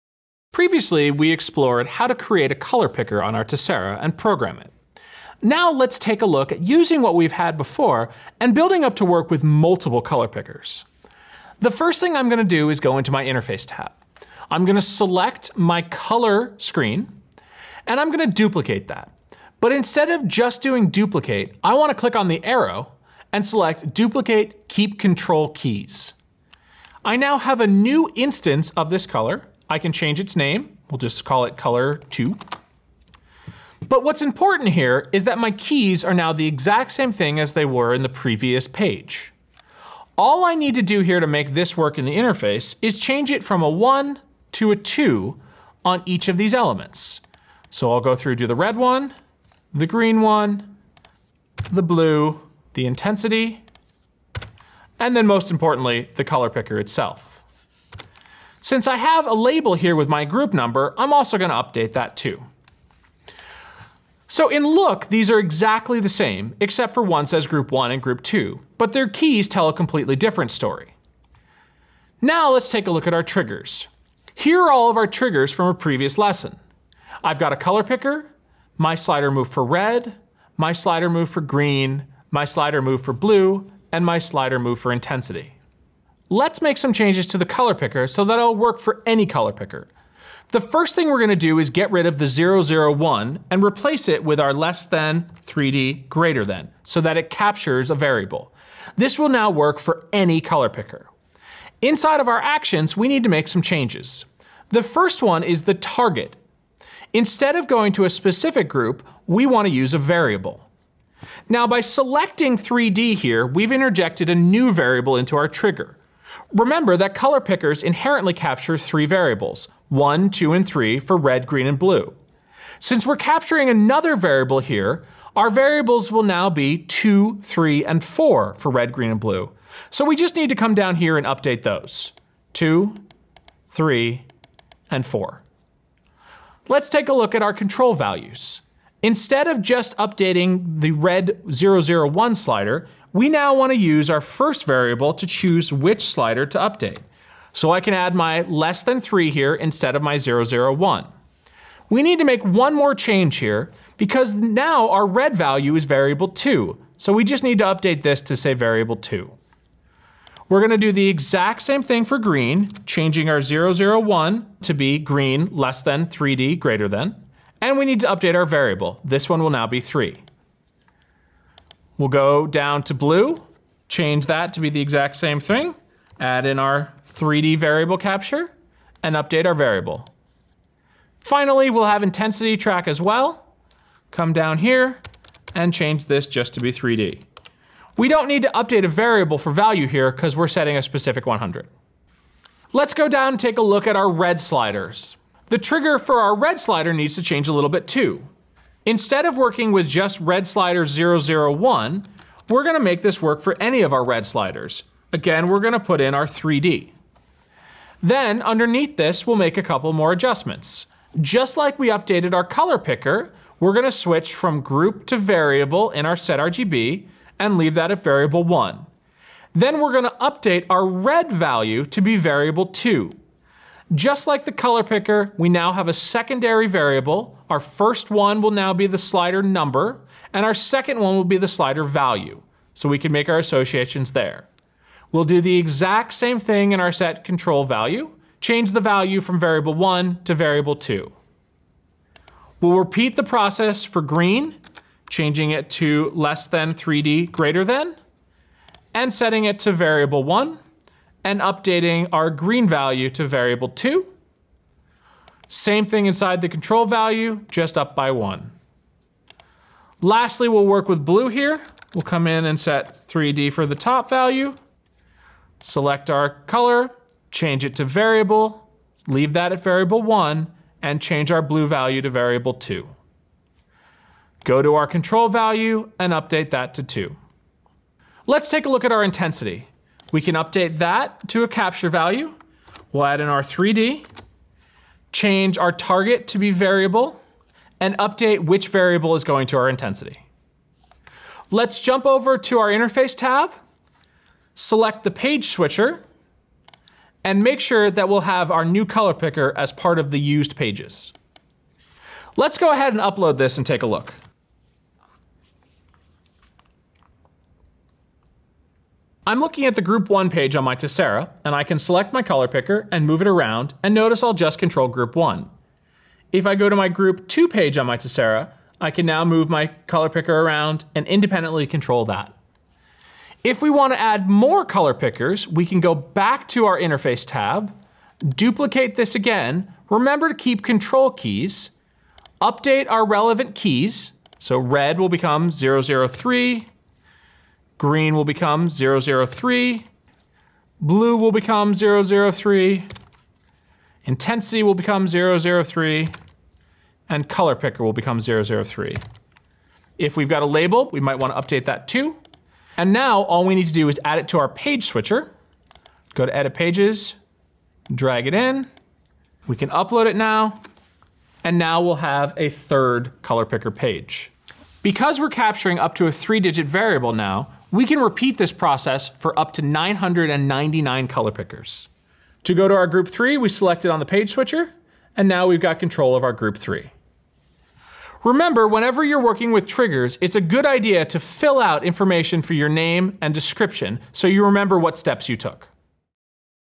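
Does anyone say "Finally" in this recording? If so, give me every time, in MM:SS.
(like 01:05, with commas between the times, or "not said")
03:01.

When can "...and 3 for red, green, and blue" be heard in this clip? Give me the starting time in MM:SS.
02:00.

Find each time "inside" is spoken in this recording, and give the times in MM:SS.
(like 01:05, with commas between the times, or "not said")
01:41, 04:16.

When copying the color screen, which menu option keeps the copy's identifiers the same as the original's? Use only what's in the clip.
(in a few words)
Duplicate keep control keys.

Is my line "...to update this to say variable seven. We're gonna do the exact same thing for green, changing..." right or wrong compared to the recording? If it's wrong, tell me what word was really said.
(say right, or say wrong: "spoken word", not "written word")
wrong: "two", not "seven".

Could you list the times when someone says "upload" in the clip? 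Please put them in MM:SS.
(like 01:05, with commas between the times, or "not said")
05:03, 05:59.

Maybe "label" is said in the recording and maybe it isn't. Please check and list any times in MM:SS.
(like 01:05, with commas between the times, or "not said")
00:59, 05:50.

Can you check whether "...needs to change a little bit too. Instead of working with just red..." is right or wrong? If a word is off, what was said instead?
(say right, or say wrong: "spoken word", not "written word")
right.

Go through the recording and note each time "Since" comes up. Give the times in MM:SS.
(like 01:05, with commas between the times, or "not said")
00:58, 02:02.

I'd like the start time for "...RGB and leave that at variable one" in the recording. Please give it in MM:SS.
03:36.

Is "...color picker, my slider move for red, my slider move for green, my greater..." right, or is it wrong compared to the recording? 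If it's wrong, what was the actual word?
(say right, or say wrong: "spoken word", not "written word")
wrong: "slider", not "greater".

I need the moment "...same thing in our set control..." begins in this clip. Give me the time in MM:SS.
03:56.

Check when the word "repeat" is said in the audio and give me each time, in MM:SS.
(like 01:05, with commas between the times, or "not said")
04:02, 06:07.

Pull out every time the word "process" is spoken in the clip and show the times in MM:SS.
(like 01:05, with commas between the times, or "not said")
04:03, 06:08.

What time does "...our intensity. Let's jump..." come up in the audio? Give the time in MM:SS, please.
04:49.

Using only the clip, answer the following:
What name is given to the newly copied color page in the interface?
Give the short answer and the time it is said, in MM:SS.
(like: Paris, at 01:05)
Color two, at 00:31.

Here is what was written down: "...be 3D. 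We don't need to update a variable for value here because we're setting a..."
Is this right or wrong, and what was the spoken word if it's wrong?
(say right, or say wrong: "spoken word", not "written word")
right.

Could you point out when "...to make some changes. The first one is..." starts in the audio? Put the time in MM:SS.
01:43.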